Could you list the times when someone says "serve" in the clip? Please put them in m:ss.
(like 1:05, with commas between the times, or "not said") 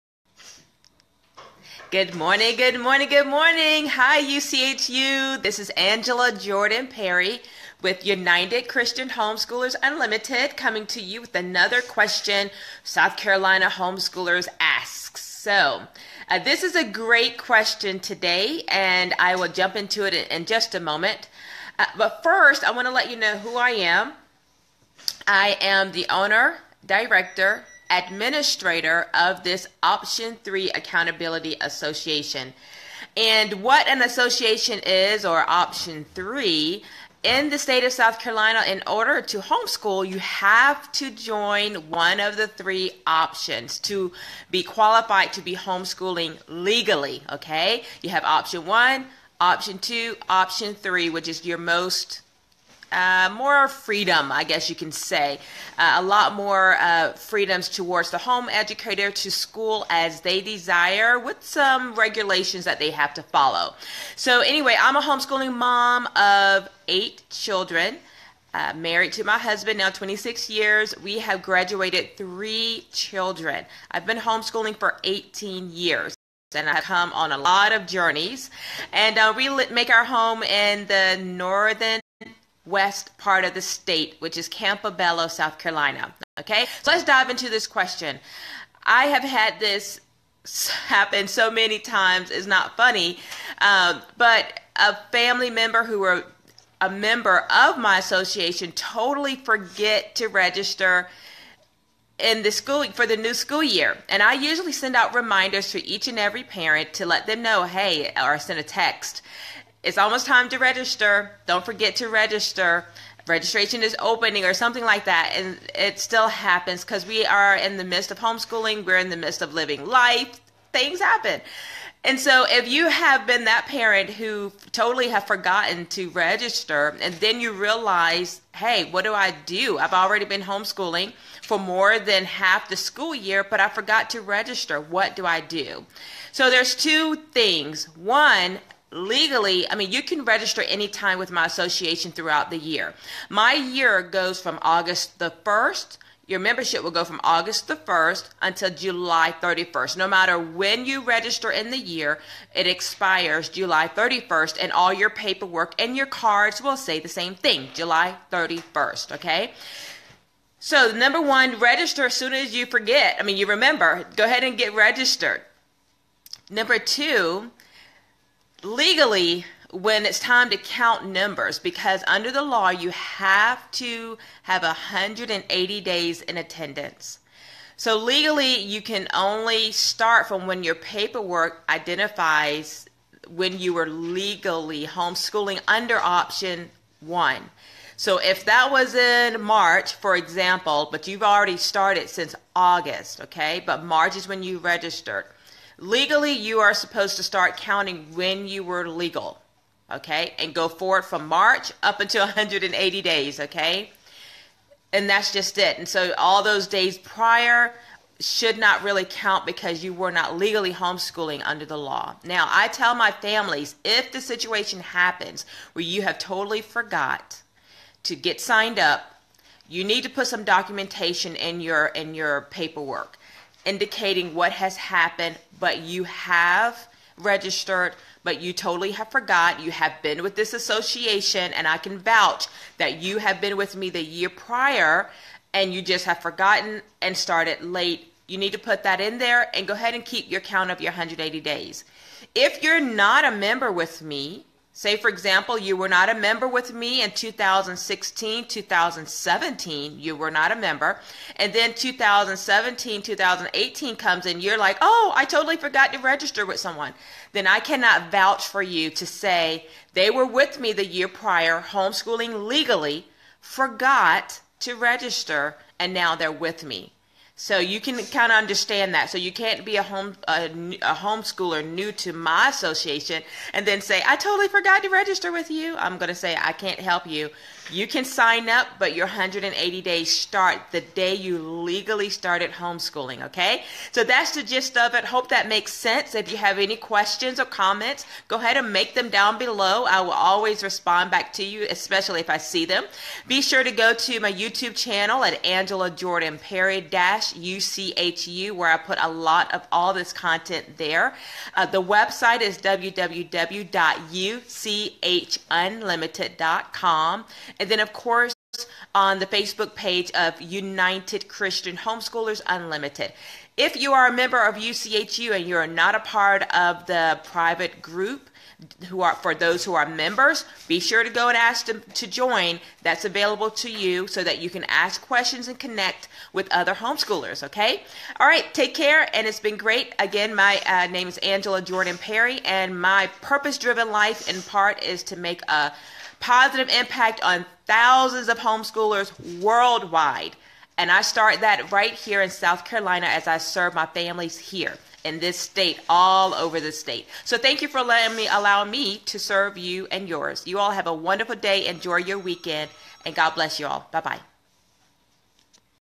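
5:43, 5:49.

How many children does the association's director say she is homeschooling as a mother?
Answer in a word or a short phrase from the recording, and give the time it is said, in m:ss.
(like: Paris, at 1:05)
8, at 1:06.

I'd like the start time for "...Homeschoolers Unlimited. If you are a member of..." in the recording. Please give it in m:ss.
5:11.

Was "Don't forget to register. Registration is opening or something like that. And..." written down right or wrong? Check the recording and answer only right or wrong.
right.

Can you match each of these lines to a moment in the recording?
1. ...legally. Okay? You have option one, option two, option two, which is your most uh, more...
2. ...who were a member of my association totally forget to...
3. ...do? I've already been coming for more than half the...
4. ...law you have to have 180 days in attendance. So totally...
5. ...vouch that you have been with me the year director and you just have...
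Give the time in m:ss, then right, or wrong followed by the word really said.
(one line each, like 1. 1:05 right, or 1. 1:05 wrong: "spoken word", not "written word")
1. 0:46 wrong: "three", not "two"
2. 1:35 right
3. 2:09 wrong: "homeschooling", not "coming"
4. 2:52 wrong: "legally", not "totally"
5. 3:51 wrong: "prior", not "director".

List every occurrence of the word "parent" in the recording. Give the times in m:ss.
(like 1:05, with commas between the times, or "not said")
1:46, 2:03.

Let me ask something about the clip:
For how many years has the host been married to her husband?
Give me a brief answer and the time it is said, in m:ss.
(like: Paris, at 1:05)
26, at 1:09.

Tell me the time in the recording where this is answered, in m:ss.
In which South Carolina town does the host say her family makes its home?
1:24.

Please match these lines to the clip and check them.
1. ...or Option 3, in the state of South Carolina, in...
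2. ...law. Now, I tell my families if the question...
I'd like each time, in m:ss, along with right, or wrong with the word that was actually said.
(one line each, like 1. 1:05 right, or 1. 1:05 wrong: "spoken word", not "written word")
1. 0:35 right
2. 3:31 wrong: "situation", not "question".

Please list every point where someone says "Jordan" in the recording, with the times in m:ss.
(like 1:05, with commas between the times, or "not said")
0:06, 4:55, 5:31.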